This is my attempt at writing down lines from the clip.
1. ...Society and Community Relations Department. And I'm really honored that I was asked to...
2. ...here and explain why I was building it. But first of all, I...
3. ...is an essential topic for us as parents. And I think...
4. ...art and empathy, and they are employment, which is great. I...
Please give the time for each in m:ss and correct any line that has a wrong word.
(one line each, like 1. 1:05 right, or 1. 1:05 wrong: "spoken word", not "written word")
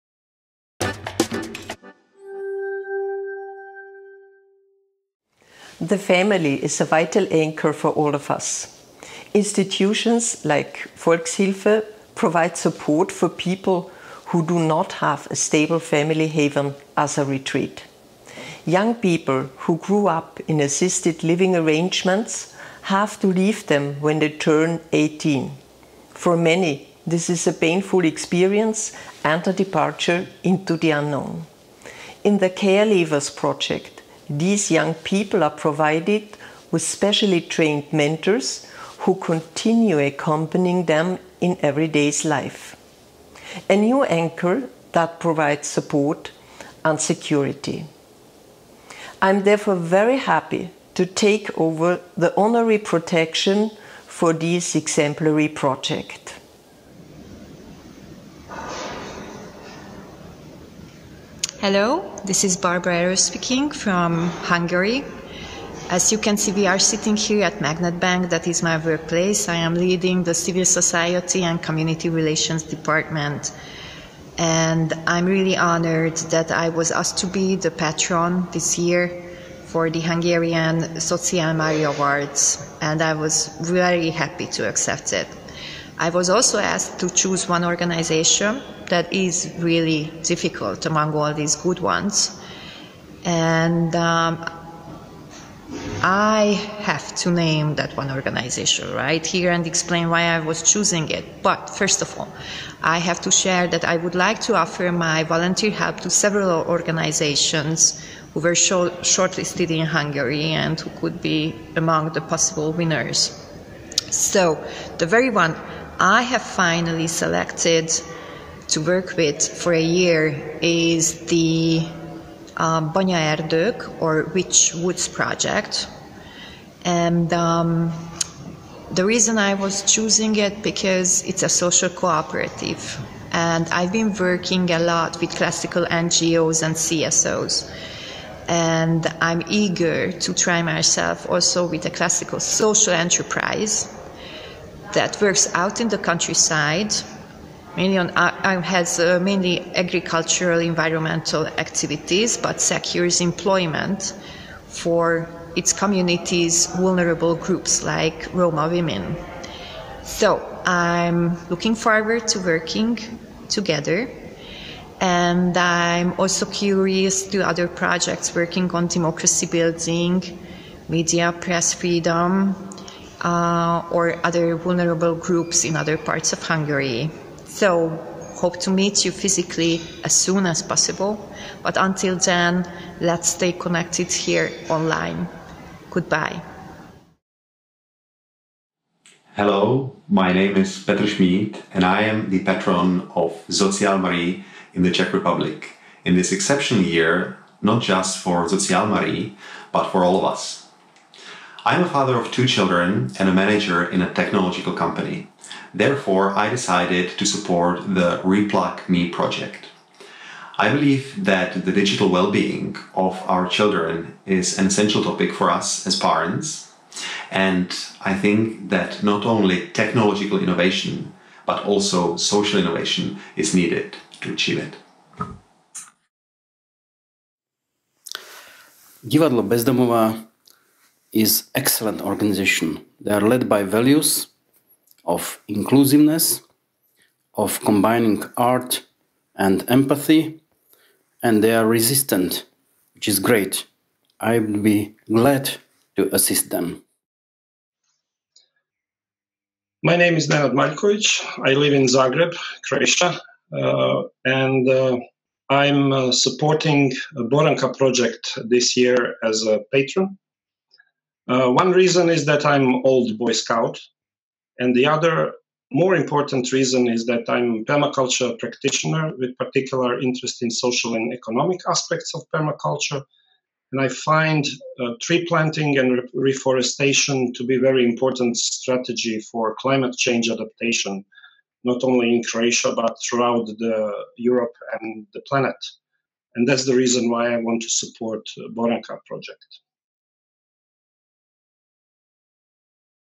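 1. 1:10 right
2. 1:39 wrong: "choosing", not "building"
3. 3:34 right
4. 3:58 wrong: "resistant", not "employment".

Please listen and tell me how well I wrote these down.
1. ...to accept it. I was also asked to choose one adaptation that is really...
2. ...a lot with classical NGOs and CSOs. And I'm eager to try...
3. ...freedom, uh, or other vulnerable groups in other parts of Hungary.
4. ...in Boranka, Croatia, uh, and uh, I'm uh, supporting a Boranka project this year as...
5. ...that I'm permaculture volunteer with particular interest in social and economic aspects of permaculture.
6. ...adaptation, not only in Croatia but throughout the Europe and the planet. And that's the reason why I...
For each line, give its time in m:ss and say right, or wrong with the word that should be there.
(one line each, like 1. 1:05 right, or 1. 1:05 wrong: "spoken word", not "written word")
1. 1:24 wrong: "organization", not "adaptation"
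2. 2:14 right
3. 2:51 right
4. 4:11 wrong: "Zagreb", not "Boranka"
5. 4:27 wrong: "practitioner", not "volunteer"
6. 4:40 right.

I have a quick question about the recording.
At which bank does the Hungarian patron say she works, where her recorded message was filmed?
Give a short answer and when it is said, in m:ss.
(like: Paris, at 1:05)
Magnet Bank, at 1:07.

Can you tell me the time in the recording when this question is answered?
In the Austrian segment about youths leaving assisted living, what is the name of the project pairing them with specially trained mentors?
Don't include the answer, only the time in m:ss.
0:32.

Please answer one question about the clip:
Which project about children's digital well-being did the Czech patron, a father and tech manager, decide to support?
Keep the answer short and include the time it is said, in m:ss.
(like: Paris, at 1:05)
Replug Me, at 3:28.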